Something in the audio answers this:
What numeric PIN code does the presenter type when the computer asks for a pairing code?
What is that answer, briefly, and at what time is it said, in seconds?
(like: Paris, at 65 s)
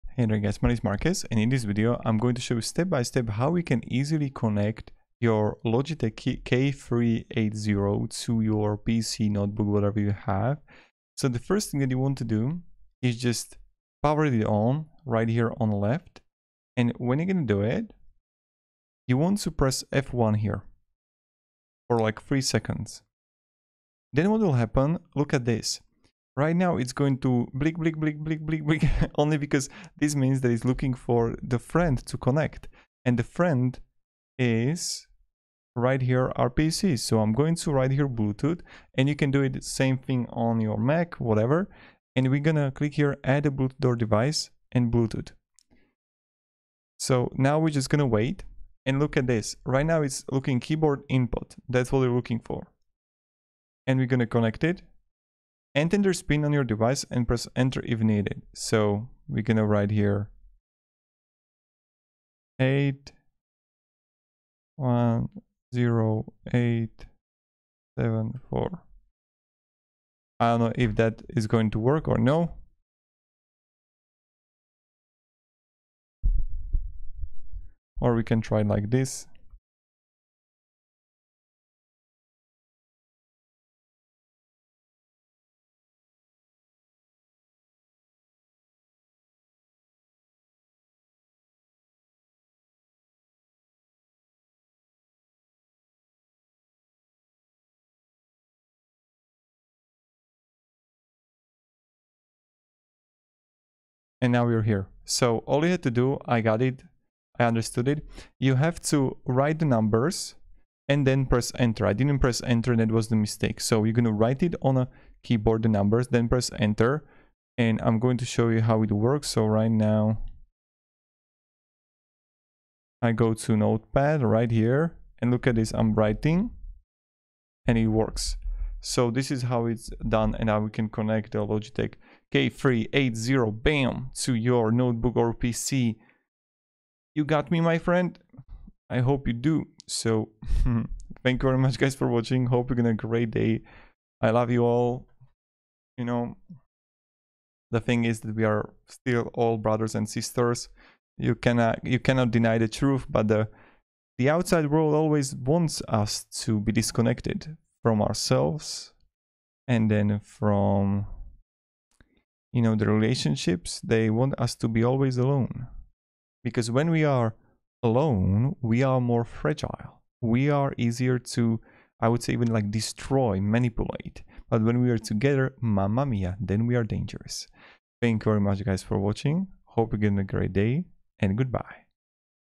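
810874, at 62 s.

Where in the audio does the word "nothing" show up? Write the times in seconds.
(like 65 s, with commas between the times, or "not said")
not said.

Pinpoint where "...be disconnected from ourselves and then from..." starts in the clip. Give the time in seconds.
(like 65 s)
156 s.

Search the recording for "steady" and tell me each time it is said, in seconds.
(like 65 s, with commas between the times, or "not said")
not said.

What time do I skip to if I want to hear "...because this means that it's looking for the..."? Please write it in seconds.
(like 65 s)
29 s.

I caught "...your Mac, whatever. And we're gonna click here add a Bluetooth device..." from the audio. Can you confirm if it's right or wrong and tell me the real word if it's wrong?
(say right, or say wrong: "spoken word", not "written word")
right.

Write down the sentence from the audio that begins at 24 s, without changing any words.
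Then what will happen, look at this.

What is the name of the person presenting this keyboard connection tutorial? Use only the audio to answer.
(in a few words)
Marcus.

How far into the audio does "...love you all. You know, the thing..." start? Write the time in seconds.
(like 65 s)
144 s.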